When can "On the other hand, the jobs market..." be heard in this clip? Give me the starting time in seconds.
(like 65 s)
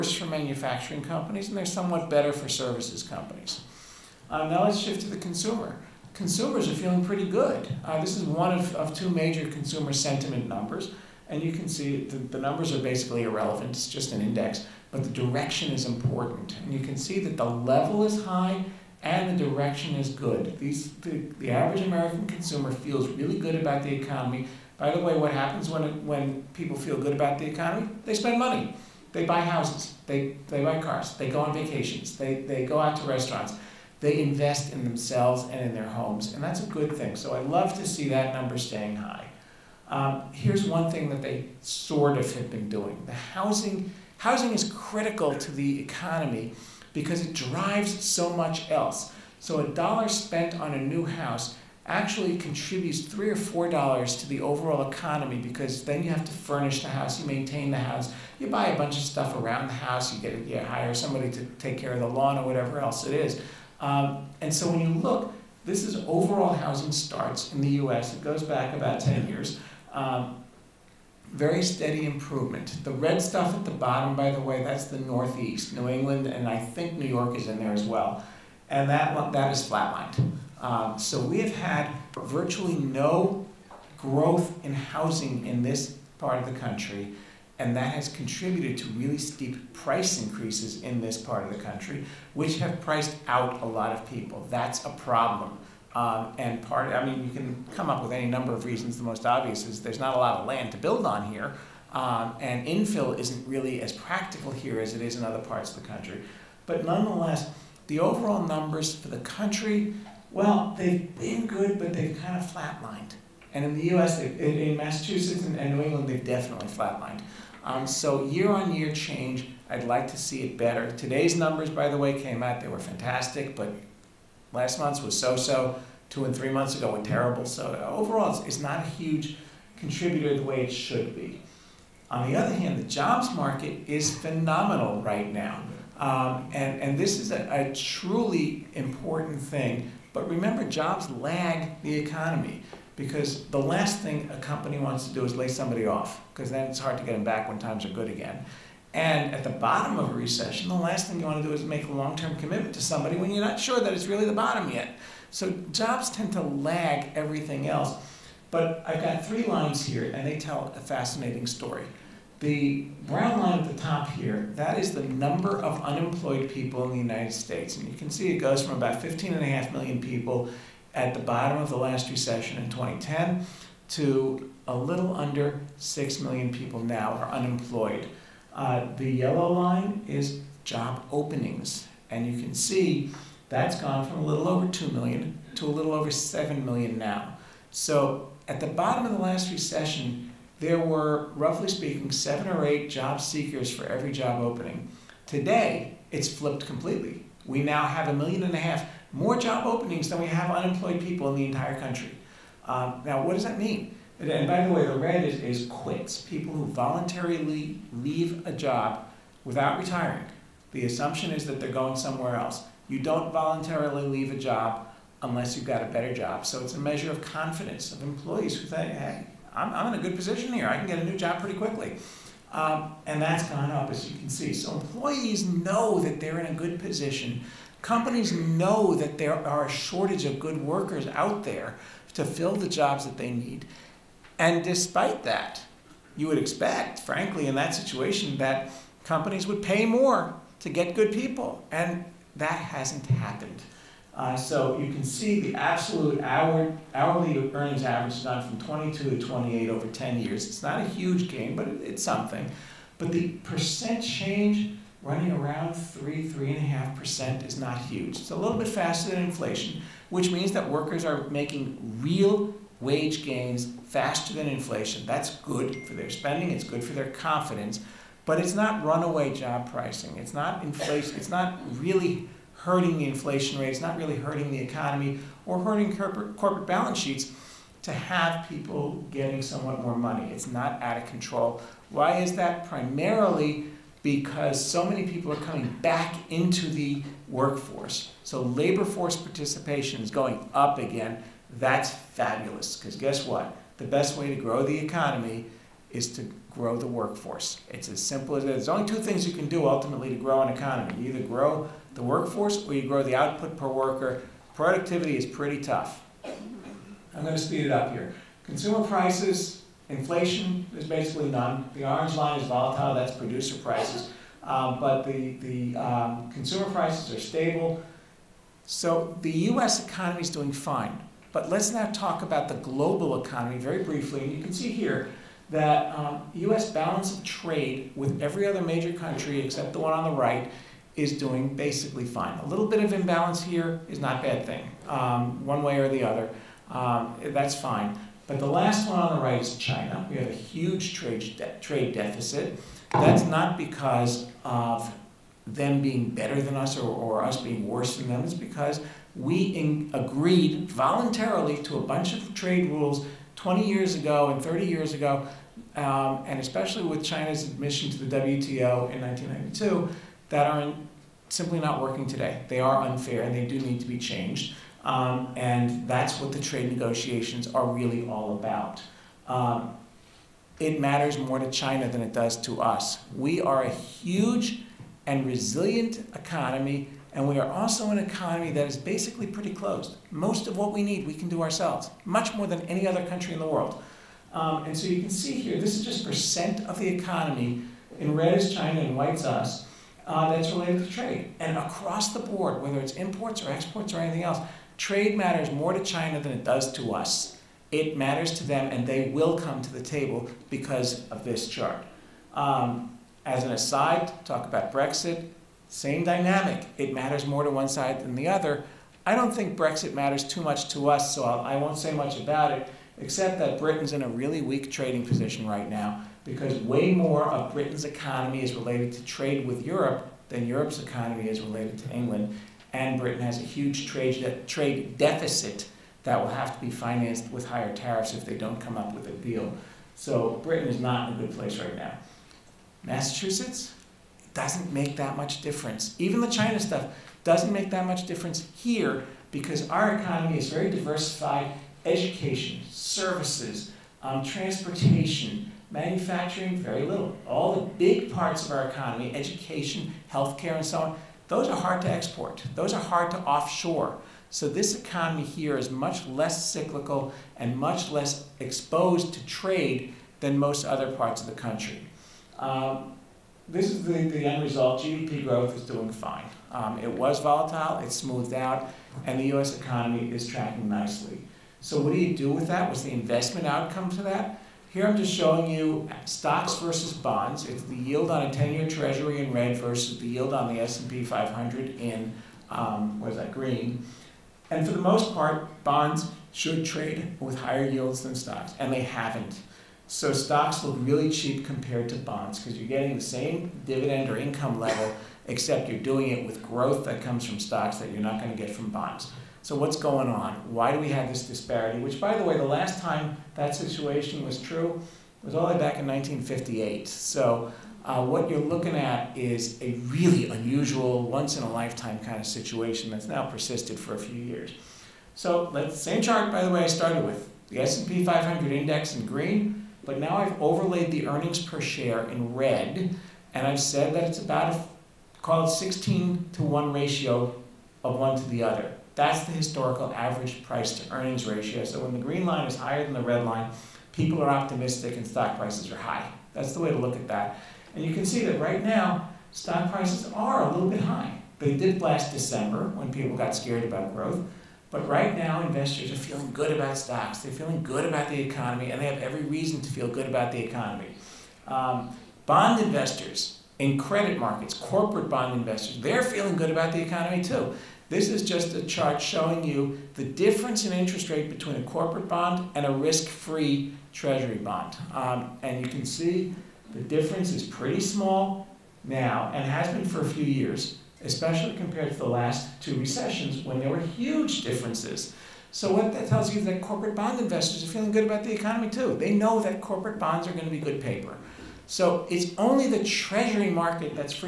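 132 s.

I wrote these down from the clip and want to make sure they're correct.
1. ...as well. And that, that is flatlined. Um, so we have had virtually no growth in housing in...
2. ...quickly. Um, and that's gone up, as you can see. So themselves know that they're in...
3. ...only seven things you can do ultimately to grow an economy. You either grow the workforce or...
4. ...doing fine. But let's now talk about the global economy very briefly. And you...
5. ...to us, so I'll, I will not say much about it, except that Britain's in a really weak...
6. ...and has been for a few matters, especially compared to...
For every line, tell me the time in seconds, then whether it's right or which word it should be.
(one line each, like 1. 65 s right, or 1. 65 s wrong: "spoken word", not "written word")
1. 77 s right
2. 221 s wrong: "employees", not "themselves"
3. 298 s wrong: "two", not "seven"
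4. 320 s right
5. 410 s right
6. 569 s wrong: "years", not "matters".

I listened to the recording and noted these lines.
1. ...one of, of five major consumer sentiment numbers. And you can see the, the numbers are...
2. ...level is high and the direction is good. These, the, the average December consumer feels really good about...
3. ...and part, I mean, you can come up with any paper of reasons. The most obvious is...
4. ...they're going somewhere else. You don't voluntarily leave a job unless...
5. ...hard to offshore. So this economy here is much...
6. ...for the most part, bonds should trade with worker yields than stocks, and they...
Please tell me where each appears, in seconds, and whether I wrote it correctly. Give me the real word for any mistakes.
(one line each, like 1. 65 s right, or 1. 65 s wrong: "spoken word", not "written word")
1. 8 s wrong: "two", not "five"
2. 17 s wrong: "American", not "December"
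3. 96 s wrong: "number", not "paper"
4. 211 s right
5. 452 s right
6. 484 s wrong: "higher", not "worker".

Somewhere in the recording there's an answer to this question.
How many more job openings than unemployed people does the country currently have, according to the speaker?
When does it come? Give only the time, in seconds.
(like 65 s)
198 s.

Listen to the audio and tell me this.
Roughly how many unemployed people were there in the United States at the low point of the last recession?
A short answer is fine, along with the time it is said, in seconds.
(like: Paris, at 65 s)
15.5 million, at 169 s.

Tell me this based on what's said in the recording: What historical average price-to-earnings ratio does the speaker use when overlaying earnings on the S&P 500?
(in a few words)
16 to 1.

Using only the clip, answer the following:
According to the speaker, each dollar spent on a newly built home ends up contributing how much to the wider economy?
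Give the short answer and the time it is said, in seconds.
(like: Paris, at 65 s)
3 or 4 dollars, at 53 s.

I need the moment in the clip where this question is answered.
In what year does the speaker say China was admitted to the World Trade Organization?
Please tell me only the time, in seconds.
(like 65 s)
359 s.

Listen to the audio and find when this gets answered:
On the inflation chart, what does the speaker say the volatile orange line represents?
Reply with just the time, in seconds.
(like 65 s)
313 s.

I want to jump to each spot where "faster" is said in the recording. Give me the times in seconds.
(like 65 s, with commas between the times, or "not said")
258 s, 263 s.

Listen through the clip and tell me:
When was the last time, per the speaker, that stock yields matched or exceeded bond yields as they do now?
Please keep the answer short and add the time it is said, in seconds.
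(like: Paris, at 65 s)
1958, at 505 s.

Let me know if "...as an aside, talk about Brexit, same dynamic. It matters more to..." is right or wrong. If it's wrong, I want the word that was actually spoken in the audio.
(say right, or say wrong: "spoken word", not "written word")
right.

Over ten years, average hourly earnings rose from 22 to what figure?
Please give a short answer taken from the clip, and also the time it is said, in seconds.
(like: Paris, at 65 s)
28, at 249 s.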